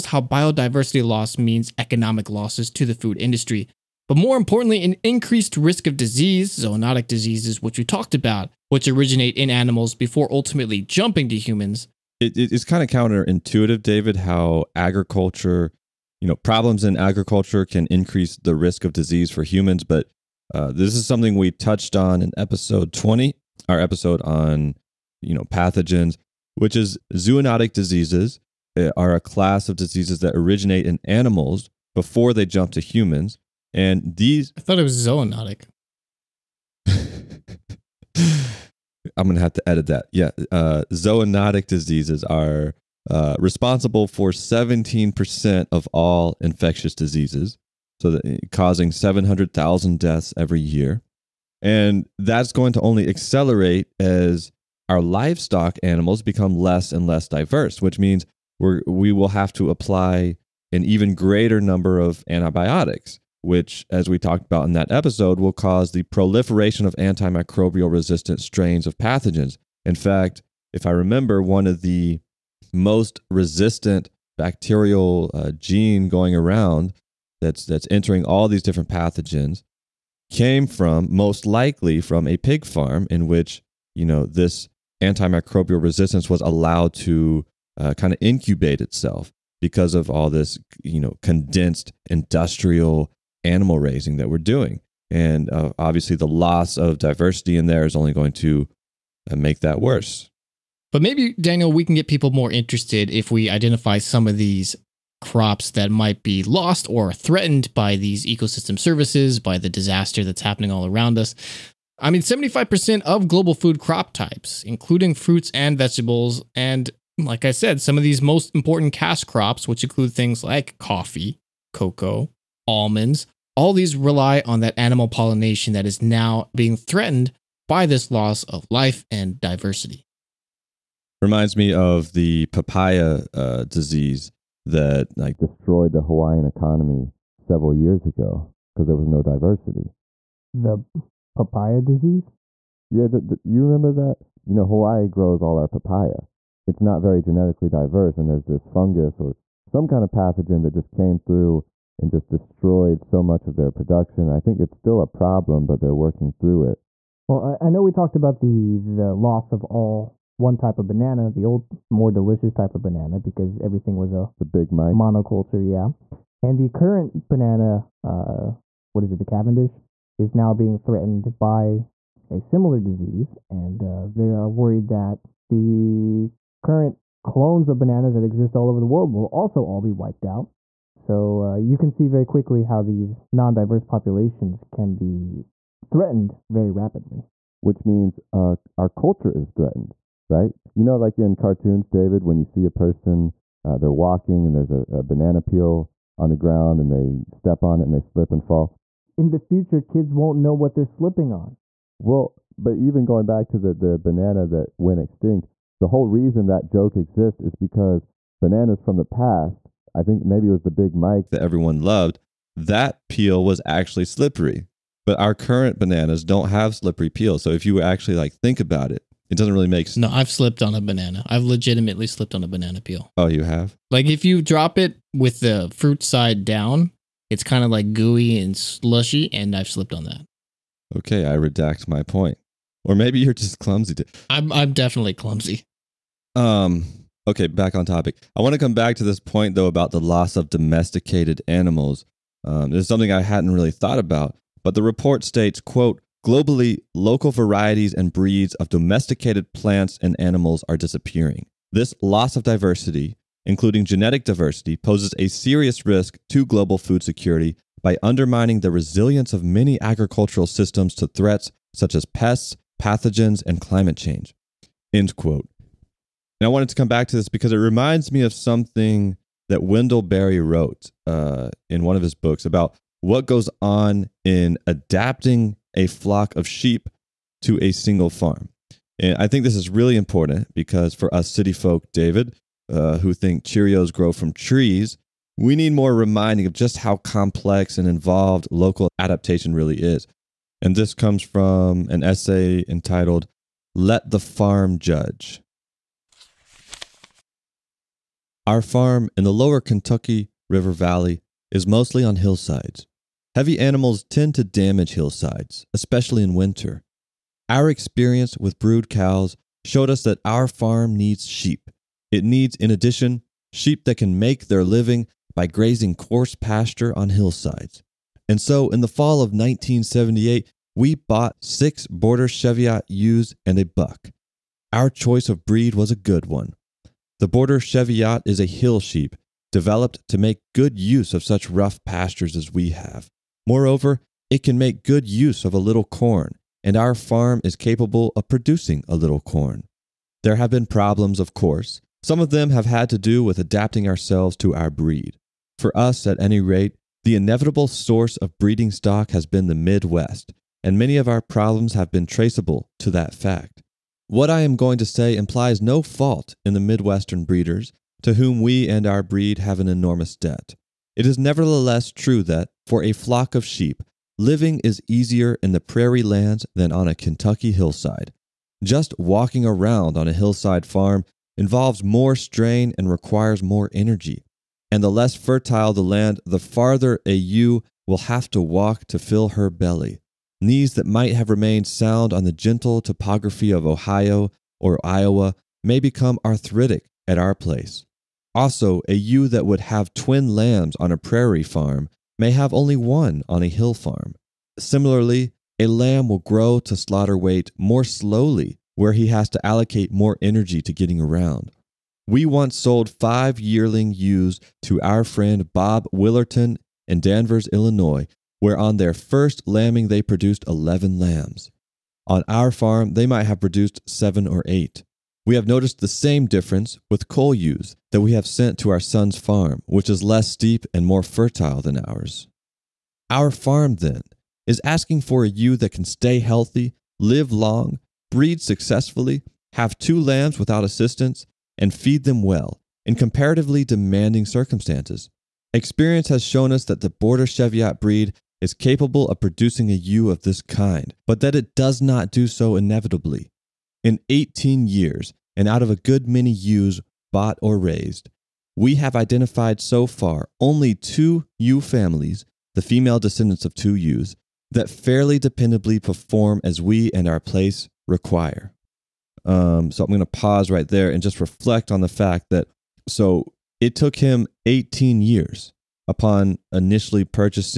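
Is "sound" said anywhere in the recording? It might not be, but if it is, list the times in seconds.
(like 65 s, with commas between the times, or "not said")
381 s.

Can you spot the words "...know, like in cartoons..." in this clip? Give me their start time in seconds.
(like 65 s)
190 s.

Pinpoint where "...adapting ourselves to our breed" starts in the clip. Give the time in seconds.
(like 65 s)
343 s.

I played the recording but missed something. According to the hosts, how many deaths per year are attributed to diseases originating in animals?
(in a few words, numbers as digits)
700,000.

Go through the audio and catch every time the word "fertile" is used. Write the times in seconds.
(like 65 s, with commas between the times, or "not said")
375 s, 421 s.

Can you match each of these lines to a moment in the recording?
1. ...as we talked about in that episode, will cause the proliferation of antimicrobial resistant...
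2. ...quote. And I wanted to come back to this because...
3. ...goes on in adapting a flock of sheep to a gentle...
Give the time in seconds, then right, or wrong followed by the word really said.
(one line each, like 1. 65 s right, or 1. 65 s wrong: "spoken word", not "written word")
1. 63 s right
2. 265 s right
3. 273 s wrong: "single", not "gentle".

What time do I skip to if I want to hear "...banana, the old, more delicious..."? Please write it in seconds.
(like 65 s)
160 s.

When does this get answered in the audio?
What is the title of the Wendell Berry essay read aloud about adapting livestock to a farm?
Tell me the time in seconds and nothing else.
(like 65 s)
293 s.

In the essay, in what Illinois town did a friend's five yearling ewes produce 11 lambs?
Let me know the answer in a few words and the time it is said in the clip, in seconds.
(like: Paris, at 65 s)
Danvers, at 406 s.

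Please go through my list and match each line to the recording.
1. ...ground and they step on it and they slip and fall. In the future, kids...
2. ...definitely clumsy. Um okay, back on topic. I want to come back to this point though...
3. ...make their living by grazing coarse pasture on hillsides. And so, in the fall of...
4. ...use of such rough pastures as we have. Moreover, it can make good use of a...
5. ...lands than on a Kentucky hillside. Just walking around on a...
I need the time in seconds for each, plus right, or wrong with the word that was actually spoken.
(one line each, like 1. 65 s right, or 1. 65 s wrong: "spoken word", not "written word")
1. 196 s right
2. 234 s right
3. 314 s right
4. 330 s right
5. 366 s right.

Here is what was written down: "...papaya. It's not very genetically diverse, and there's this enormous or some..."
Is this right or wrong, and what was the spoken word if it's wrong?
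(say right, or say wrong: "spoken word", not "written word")
wrong: "fungus", not "enormous".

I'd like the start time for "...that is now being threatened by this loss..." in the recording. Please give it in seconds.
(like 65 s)
125 s.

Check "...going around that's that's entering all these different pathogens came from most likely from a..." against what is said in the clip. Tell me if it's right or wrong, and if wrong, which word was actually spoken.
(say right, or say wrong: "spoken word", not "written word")
right.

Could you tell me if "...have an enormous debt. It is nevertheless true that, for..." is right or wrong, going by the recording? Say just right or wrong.
right.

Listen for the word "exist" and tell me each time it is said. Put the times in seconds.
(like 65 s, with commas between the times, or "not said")
178 s, 206 s.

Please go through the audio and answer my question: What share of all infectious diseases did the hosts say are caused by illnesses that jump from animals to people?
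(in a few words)
17%.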